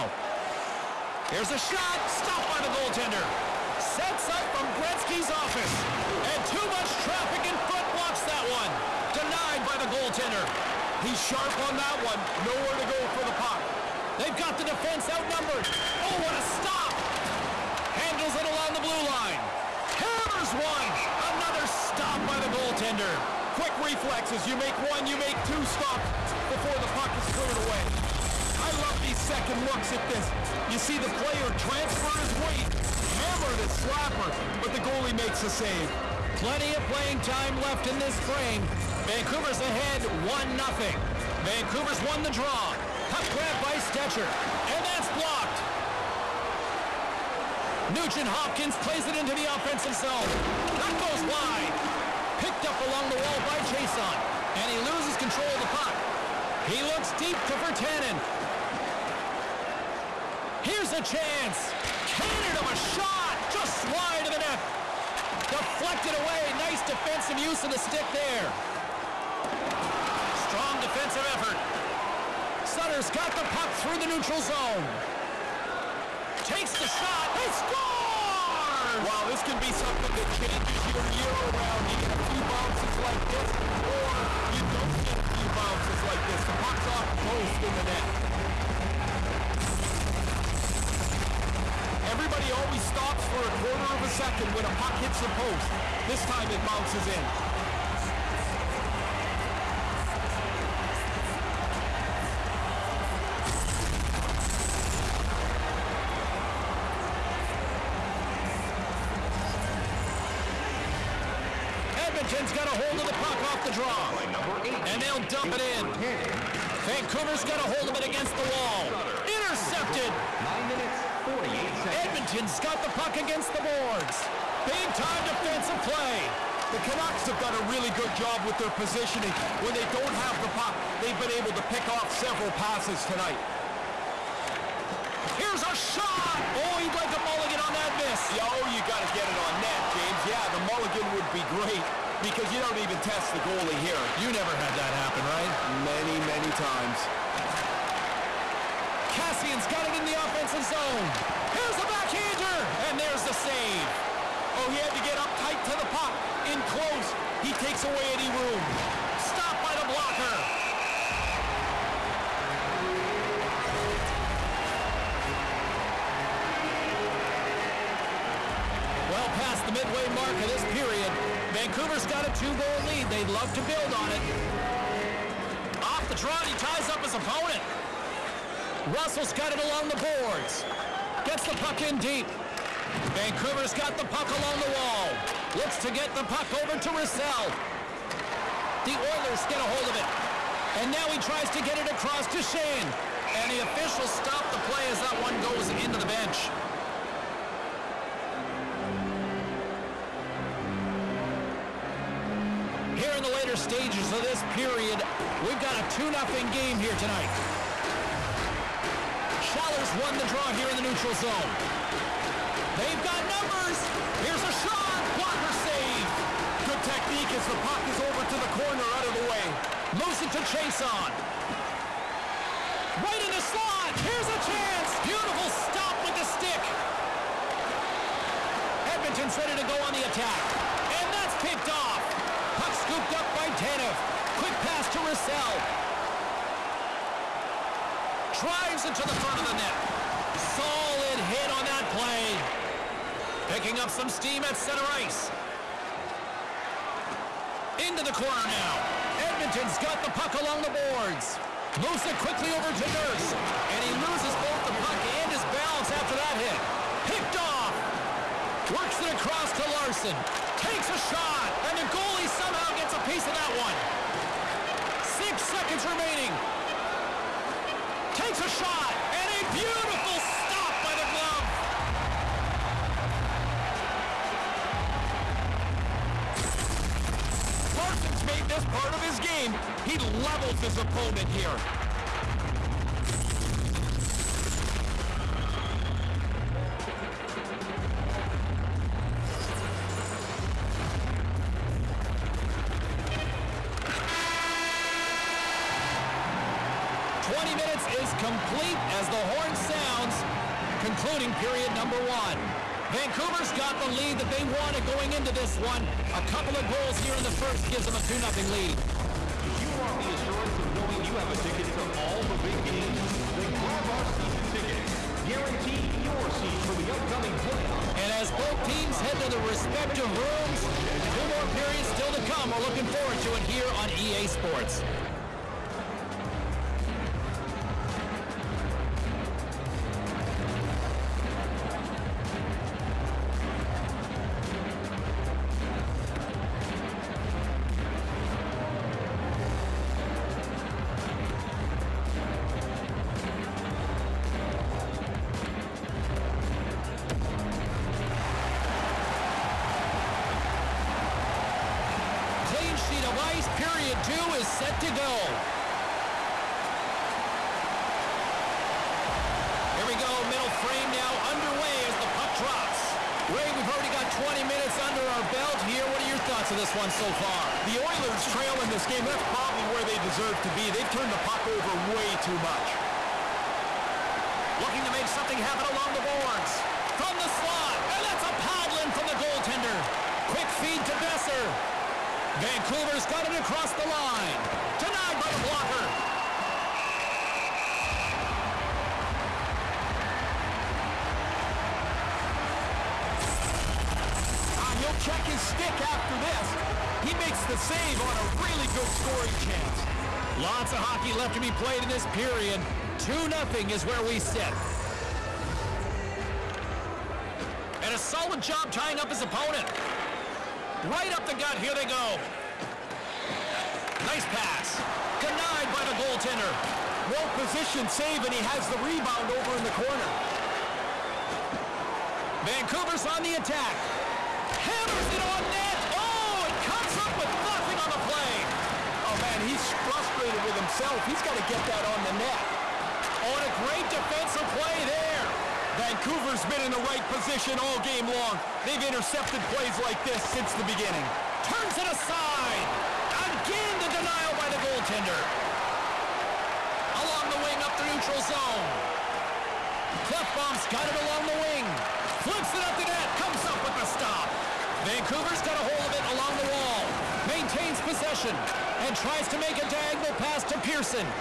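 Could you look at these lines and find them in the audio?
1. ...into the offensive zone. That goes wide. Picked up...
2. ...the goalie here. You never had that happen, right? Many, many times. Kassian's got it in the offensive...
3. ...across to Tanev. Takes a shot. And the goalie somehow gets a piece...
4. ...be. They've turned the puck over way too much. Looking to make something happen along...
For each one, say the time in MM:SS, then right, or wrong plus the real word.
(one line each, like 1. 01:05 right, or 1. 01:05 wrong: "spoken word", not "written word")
1. 00:49 right
2. 02:23 right
3. 04:19 wrong: "Larsson", not "Tanev"
4. 06:10 right.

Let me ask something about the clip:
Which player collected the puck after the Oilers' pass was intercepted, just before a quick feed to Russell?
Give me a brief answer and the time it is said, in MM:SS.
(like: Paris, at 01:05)
Tanev, at 03:53.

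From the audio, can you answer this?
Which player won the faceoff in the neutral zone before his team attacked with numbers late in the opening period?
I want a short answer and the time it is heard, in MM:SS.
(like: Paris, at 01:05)
Schaller, at 03:29.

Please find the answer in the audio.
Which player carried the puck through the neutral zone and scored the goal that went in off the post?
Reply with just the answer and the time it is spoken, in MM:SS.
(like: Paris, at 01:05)
Sutter, at 01:12.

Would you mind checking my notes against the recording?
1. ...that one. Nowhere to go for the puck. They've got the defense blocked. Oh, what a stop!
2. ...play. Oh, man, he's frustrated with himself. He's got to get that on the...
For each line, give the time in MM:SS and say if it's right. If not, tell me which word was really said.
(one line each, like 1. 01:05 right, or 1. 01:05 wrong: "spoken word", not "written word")
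1. 00:11 wrong: "outnumbered", not "blocked"
2. 07:08 right.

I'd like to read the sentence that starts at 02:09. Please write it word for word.
When they don't have the puck, they've been able to pick off several passes tonight.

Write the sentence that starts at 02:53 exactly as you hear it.
They'd love to build on it.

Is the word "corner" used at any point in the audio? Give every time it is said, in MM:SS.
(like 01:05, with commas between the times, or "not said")
03:38, 04:08, 06:59.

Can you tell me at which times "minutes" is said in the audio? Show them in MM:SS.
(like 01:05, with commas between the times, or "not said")
02:00, 06:04.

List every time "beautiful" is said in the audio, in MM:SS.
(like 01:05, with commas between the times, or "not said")
03:45, 04:29.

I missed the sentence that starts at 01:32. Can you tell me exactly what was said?
Everybody always stops for a quarter of a second when a puck hits the post.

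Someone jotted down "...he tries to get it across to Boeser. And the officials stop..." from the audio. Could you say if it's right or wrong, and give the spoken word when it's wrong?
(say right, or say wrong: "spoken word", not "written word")
wrong: "Shane", not "Boeser".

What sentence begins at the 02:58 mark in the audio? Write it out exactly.
Russell's got it along the boards.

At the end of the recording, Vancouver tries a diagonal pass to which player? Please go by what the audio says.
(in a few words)
Pearson.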